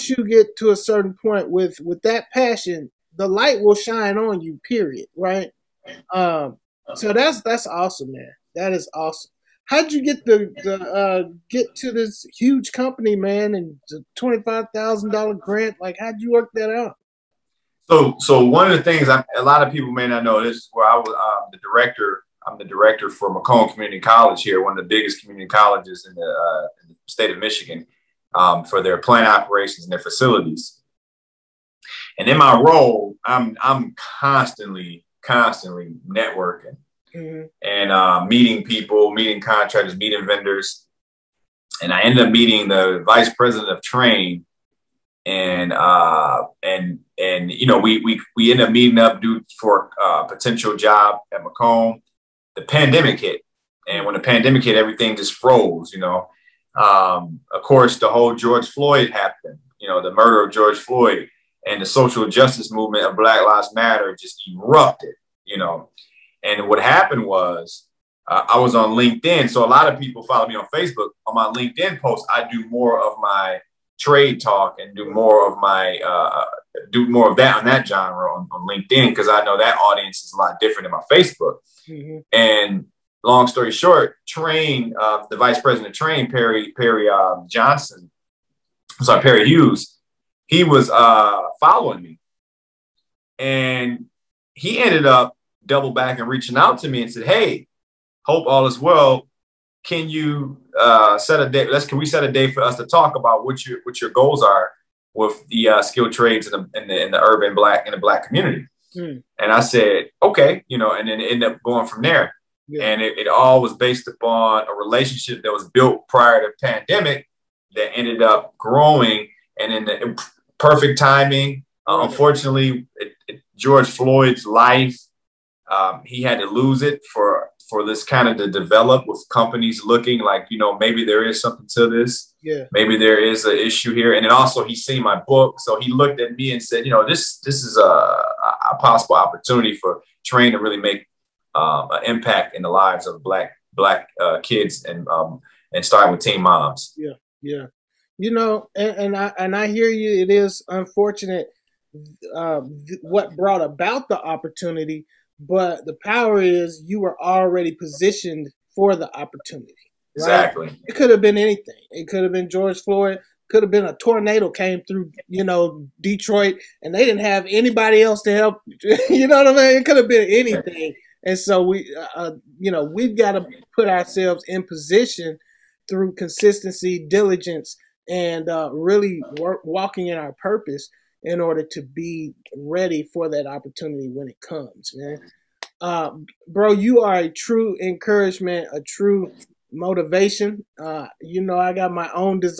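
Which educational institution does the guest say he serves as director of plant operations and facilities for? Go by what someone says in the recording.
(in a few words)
Macomb Community College.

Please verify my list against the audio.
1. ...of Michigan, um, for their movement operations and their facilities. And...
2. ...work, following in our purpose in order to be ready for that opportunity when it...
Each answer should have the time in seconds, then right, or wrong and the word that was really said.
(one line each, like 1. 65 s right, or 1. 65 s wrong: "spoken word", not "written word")
1. 27 s wrong: "plant", not "movement"
2. 179 s wrong: "walking", not "following".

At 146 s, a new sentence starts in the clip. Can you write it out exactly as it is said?
Yeah, yeah you know, and, and I and I hear you.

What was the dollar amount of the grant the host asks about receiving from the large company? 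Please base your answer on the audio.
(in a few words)
$25,000.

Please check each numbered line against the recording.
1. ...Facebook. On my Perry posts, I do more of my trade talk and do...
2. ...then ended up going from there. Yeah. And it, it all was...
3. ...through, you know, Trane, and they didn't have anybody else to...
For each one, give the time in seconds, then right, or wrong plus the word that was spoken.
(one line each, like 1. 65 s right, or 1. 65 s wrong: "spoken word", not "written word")
1. 70 s wrong: "LinkedIn", not "Perry"
2. 111 s right
3. 164 s wrong: "Detroit", not "Trane".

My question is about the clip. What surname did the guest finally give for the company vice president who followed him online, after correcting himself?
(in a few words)
Hughes.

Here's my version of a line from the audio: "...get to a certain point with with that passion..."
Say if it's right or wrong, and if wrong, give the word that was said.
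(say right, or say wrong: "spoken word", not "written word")
right.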